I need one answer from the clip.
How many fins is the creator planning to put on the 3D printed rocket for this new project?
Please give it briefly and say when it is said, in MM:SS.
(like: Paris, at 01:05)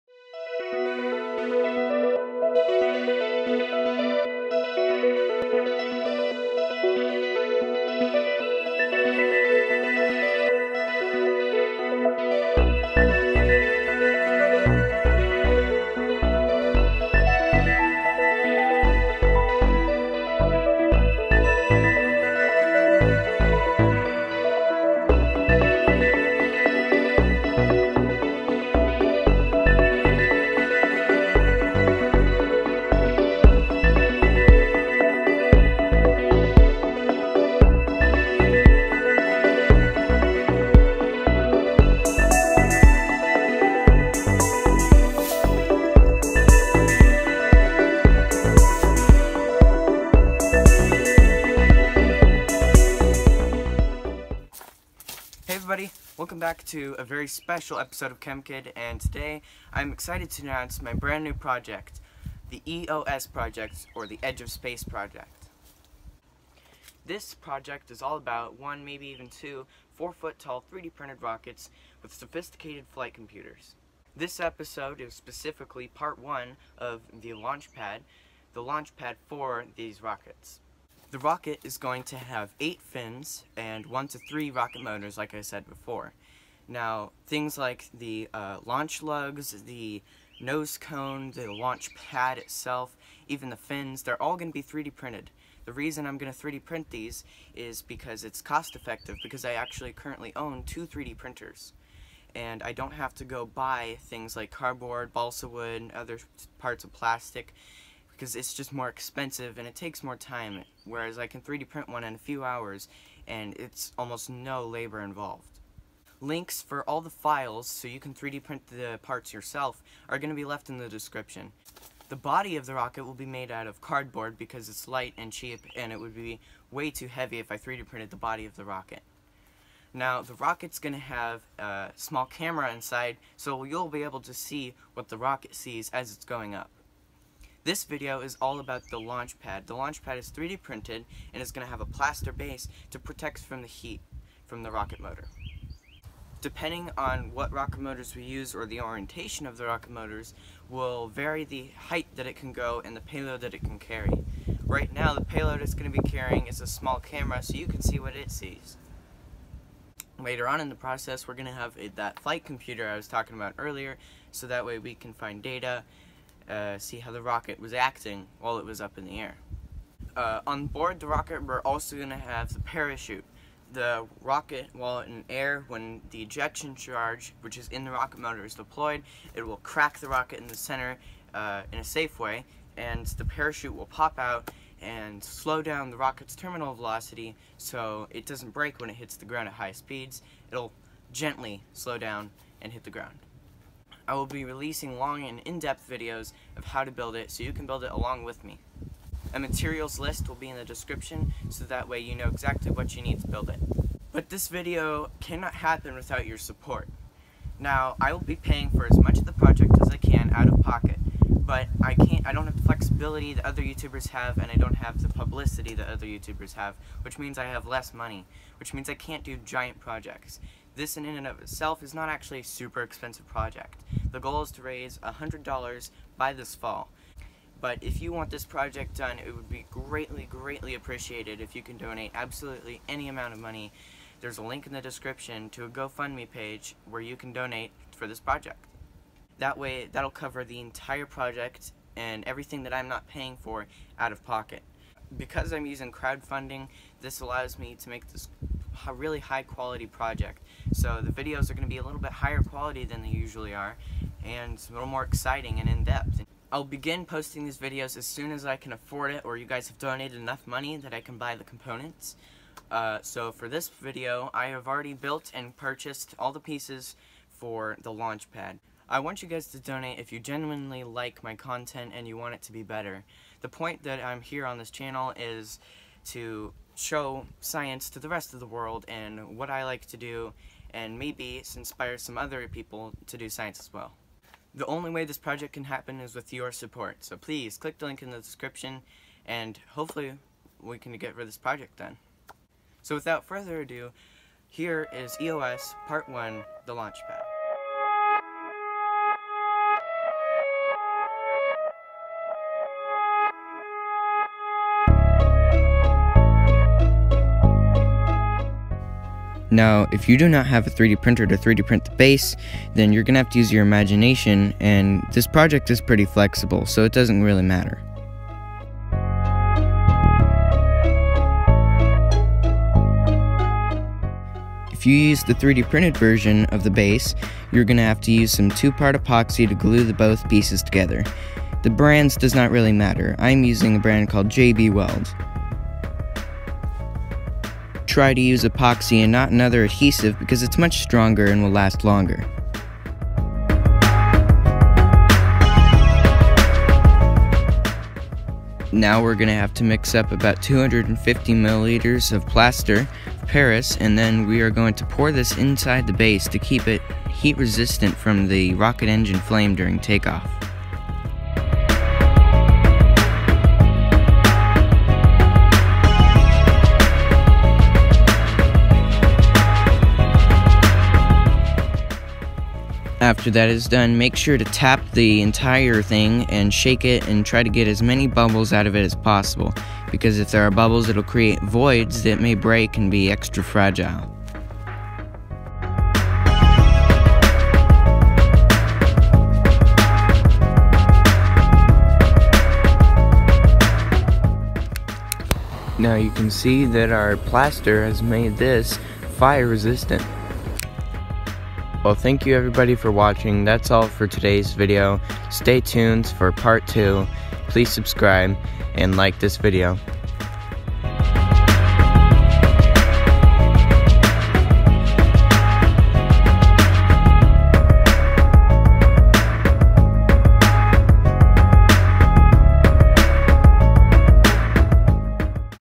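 8, at 01:22.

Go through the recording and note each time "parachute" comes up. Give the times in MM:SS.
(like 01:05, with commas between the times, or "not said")
02:52, 03:03.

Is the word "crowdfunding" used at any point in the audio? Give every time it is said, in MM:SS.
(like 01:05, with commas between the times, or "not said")
04:05.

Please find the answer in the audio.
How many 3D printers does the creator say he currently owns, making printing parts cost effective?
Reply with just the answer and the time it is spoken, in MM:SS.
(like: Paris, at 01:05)
2, at 01:40.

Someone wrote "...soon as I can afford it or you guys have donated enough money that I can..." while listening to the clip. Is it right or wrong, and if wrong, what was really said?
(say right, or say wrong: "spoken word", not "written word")
right.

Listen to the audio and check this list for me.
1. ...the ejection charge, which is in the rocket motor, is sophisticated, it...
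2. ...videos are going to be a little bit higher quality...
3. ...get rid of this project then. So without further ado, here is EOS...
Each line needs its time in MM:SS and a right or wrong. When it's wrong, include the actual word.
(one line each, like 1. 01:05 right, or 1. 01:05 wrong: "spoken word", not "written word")
1. 02:56 wrong: "deployed", not "sophisticated"
2. 04:11 right
3. 04:50 right.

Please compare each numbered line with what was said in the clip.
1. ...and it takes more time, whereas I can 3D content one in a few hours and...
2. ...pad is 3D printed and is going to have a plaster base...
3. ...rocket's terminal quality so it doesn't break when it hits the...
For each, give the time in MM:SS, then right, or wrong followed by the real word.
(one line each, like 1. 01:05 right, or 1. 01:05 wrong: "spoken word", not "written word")
1. 01:49 wrong: "print", not "content"
2. 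02:20 right
3. 03:05 wrong: "velocity", not "quality".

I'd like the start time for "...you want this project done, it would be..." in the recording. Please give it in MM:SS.
03:48.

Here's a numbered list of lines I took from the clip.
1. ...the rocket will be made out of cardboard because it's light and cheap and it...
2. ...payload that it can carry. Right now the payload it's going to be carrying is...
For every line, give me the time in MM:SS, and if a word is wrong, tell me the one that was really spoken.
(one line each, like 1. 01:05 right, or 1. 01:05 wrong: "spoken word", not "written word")
1. 02:02 right
2. 02:33 right.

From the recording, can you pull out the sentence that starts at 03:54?
There's a link in the description to a GoFundMe page where you can donate for this project.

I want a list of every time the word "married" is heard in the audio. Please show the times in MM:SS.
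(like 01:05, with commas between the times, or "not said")
not said.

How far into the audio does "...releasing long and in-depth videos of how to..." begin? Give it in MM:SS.
03:14.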